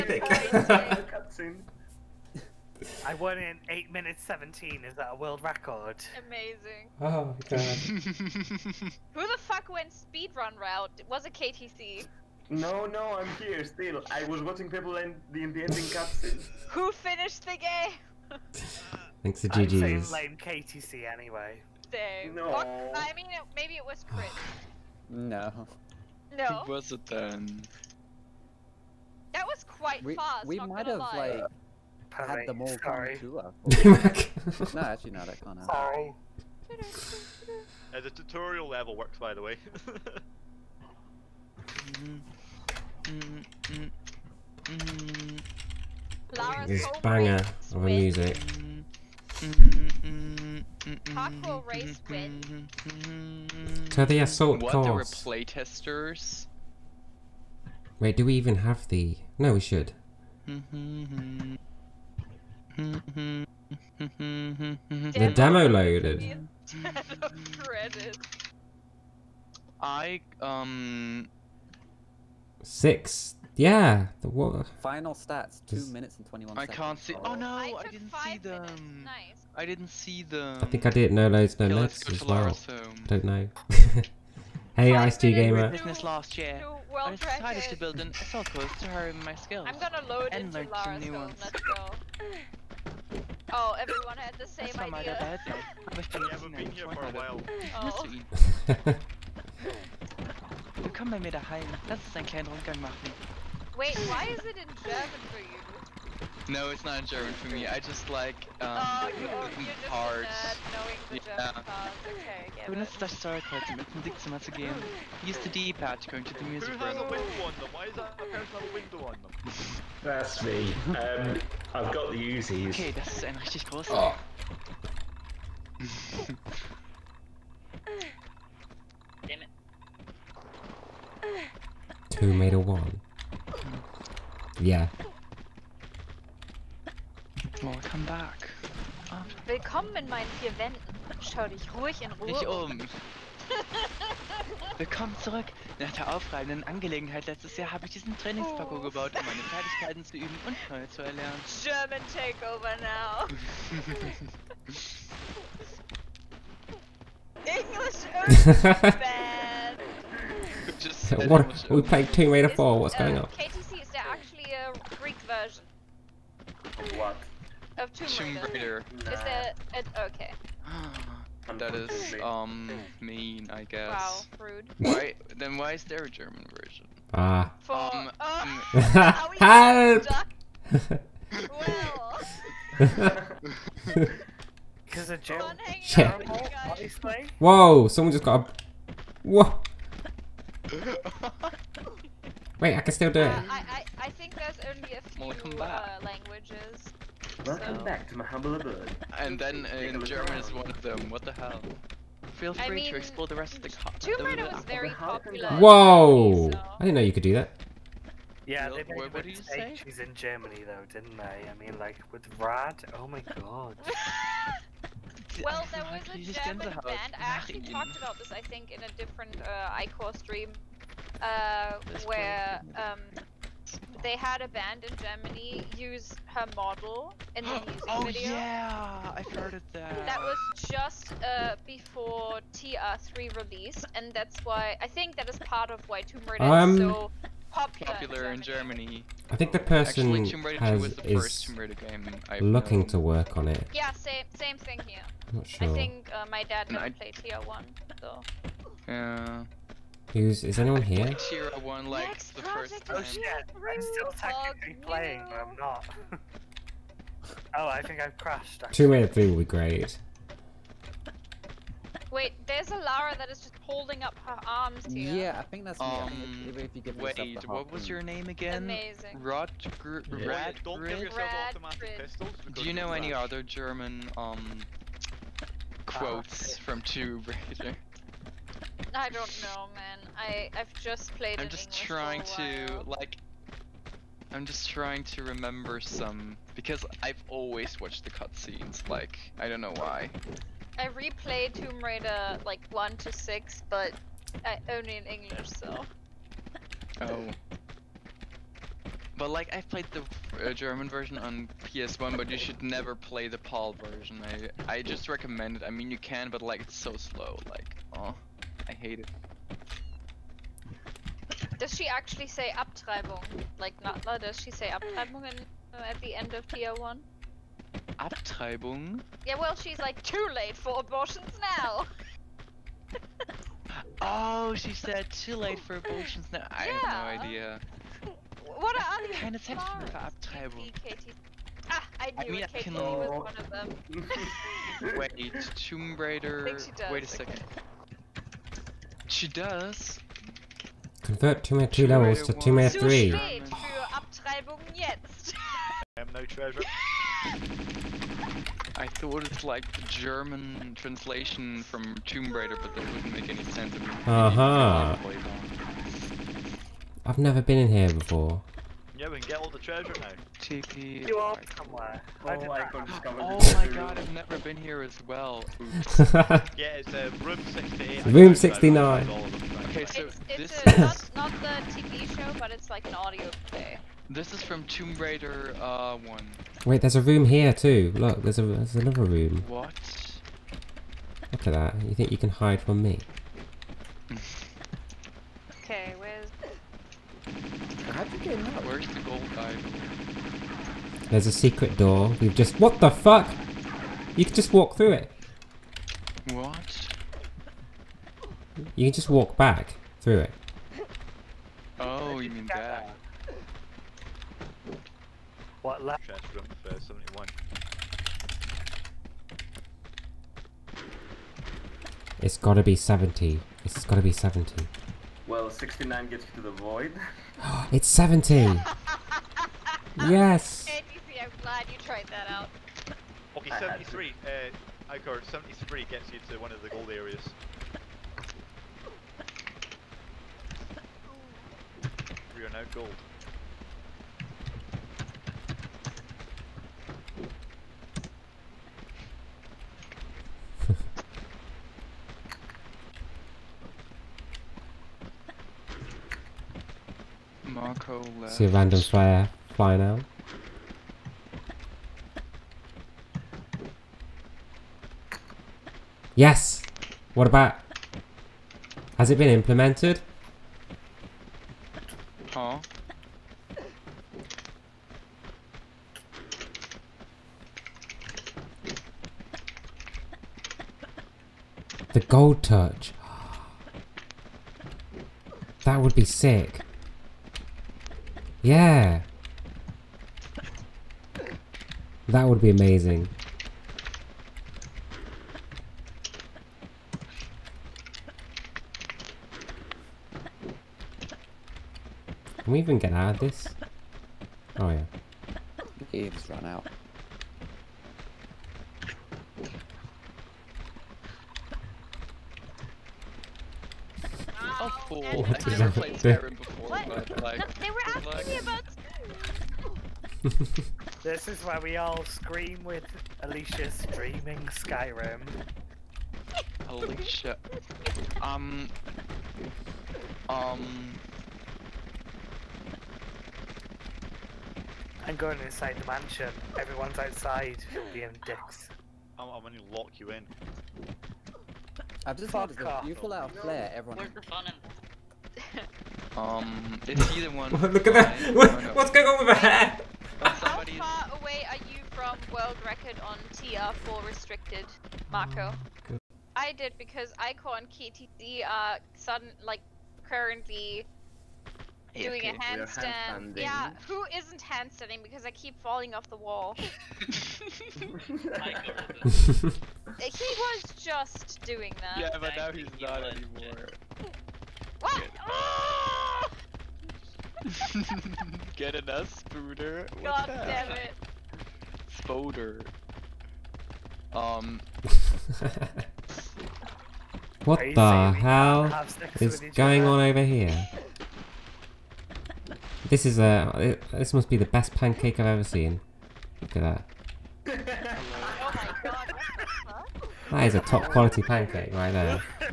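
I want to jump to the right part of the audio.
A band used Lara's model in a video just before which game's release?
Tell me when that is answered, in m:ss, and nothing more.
3:52.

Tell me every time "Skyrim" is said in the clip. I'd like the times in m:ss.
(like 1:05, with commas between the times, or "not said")
8:25, 8:34.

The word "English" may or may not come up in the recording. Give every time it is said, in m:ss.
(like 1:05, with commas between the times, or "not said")
2:37, 4:41, 4:55.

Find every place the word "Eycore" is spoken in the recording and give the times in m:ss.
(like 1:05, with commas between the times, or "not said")
3:39, 7:04.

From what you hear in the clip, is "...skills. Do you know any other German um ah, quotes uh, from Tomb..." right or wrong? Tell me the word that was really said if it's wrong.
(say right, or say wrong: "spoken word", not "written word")
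wrong: "pistols", not "skills".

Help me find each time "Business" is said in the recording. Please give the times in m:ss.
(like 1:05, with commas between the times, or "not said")
1:25.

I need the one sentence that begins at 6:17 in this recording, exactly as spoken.
Look, there's, a, there's another room.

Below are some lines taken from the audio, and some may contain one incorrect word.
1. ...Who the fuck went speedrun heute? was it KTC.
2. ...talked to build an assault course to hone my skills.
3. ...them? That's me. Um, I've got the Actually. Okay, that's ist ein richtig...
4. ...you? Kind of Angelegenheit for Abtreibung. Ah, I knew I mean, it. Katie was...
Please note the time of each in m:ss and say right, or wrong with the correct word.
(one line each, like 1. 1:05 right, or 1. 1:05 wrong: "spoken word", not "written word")
1. 0:09 wrong: "route", not "heute"
2. 1:27 wrong: "decided", not "talked"
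3. 1:59 wrong: "Uzis", not "Actually"
4. 5:29 wrong: "Zeit", not "Angelegenheit".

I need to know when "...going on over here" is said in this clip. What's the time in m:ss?
9:39.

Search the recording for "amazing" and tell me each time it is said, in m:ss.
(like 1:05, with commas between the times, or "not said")
0:06, 4:28, 8:02.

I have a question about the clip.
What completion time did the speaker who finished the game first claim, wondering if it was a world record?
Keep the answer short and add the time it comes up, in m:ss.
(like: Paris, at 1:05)
8 minutes 17, at 0:03.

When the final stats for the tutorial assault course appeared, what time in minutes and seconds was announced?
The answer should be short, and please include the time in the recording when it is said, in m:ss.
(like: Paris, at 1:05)
2 minutes 21 seconds, at 1:15.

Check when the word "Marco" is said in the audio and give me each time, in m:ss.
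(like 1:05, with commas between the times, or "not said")
7:27, 9:05.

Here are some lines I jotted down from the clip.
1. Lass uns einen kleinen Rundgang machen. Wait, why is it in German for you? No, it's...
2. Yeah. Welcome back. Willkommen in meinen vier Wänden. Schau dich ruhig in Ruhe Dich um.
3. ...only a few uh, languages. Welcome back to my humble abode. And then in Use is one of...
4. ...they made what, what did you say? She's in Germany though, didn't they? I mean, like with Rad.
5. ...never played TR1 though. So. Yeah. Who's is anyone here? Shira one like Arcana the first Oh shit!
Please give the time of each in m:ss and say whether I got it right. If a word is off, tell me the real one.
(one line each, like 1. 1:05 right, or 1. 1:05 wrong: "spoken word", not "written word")
1. 1:41 right
2. 2:14 right
3. 3:14 wrong: "German", not "Use"
4. 3:28 right
5. 4:06 wrong: "Next", not "Arcana".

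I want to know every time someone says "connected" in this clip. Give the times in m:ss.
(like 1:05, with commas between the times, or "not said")
not said.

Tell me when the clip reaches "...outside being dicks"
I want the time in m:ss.
8:46.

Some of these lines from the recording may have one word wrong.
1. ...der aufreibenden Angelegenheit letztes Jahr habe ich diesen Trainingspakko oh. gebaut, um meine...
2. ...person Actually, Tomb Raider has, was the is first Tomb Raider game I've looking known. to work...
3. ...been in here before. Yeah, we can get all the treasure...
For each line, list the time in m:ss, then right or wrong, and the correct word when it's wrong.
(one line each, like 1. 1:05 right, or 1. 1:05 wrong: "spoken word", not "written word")
1. 2:25 right
2. 3:59 right
3. 5:57 right.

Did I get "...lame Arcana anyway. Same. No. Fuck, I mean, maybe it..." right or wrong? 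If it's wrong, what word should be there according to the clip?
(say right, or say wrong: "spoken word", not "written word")
wrong: "KTC", not "Arcana".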